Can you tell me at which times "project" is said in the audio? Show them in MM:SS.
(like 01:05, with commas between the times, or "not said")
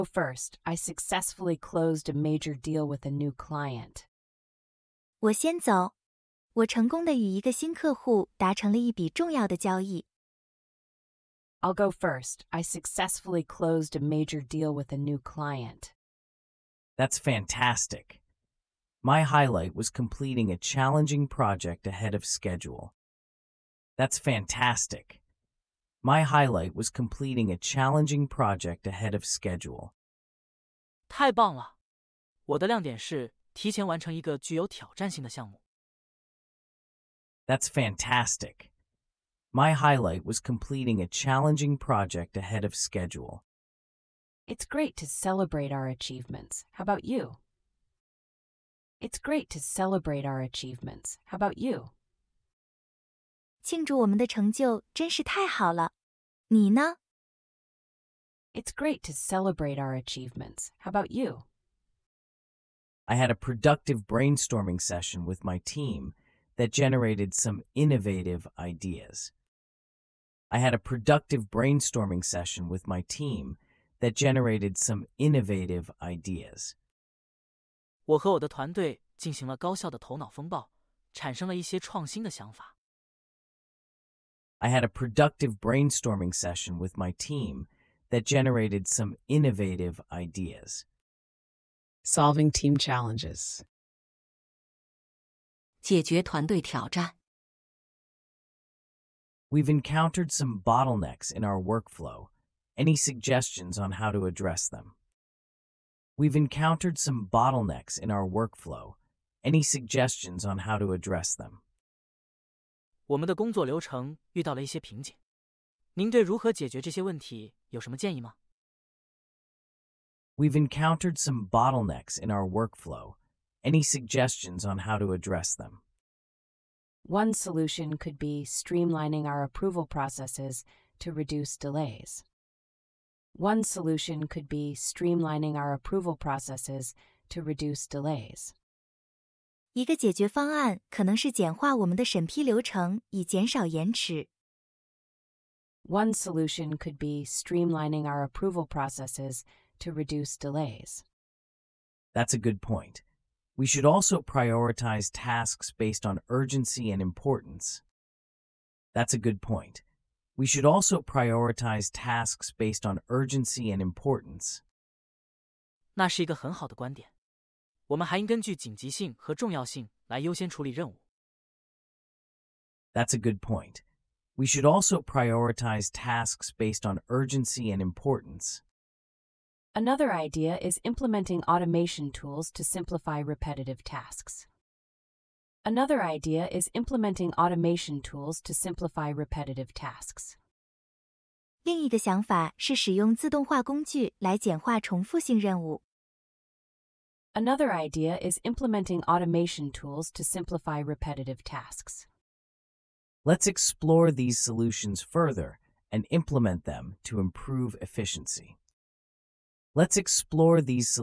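00:21, 00:28, 00:41.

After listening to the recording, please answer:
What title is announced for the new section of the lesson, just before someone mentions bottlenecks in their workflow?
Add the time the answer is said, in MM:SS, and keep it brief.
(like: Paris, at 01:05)
Solving team challenges, at 01:32.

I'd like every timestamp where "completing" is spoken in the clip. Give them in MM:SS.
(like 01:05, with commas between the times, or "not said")
00:19, 00:26, 00:40.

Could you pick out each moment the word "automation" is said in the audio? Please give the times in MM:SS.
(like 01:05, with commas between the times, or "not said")
03:01, 03:07, 03:19.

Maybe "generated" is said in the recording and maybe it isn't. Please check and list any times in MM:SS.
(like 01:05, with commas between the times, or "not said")
01:06, 01:14, 01:28.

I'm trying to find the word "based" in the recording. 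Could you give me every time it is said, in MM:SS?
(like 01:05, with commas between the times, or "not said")
02:35, 02:42, 02:56.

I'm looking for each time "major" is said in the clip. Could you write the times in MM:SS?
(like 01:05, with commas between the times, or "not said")
00:02, 00:14.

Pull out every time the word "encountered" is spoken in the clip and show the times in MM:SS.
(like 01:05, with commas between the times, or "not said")
01:39, 01:46, 02:00.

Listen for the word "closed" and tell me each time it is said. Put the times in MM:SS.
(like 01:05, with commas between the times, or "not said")
00:01, 00:13.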